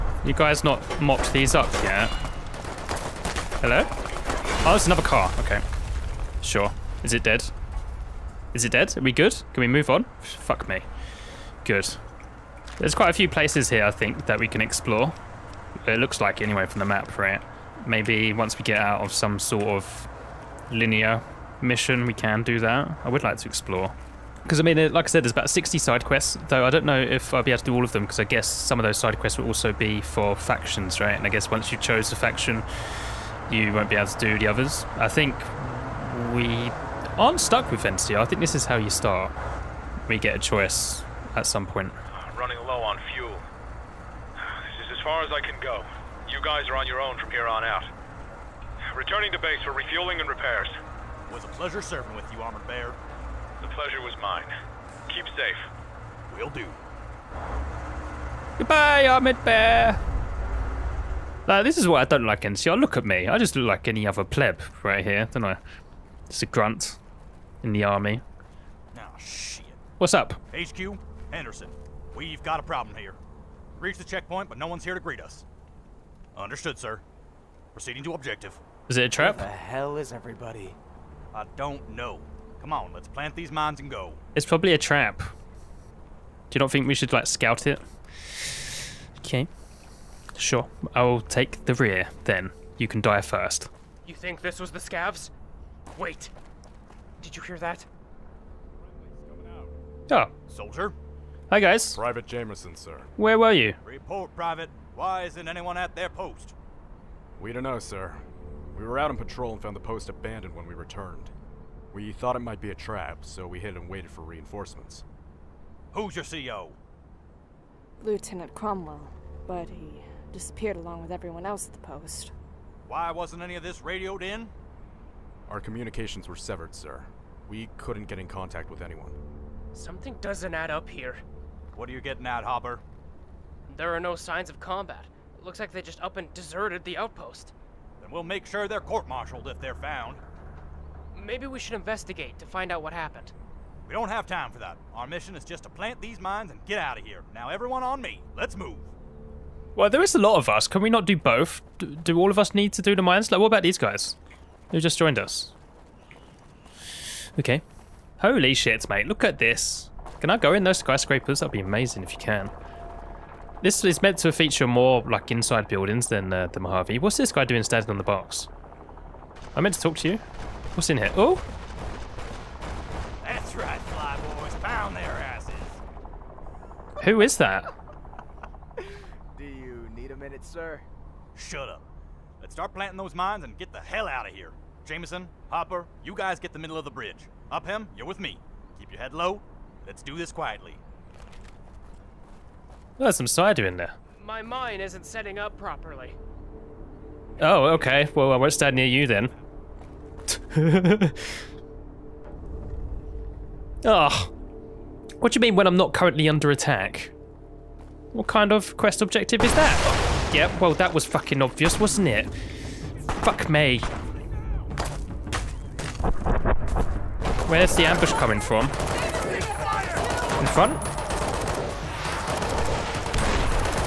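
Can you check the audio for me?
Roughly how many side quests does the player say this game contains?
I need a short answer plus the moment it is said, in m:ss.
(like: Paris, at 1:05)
60, at 0:25.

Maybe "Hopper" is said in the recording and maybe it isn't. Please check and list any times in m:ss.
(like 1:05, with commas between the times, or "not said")
2:12, 3:05.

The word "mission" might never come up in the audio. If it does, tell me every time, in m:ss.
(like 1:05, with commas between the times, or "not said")
0:21, 2:25.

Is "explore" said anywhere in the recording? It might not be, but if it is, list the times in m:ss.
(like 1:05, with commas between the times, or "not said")
0:14, 0:23.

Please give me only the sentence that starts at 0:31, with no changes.
And I guess once you chose a faction, you won't be able to do the others.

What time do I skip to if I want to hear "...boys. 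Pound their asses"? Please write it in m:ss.
2:54.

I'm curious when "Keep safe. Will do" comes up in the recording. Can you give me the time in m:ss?
0:55.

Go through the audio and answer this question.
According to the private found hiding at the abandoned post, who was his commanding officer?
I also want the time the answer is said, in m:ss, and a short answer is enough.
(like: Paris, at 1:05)
Lieutenant Cromwell, at 1:58.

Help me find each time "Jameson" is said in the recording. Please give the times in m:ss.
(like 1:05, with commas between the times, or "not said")
1:42, 3:04.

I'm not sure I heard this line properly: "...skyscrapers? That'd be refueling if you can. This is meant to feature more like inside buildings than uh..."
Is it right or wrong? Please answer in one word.
wrong.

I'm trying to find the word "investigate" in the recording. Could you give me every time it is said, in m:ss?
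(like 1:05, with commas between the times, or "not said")
2:21.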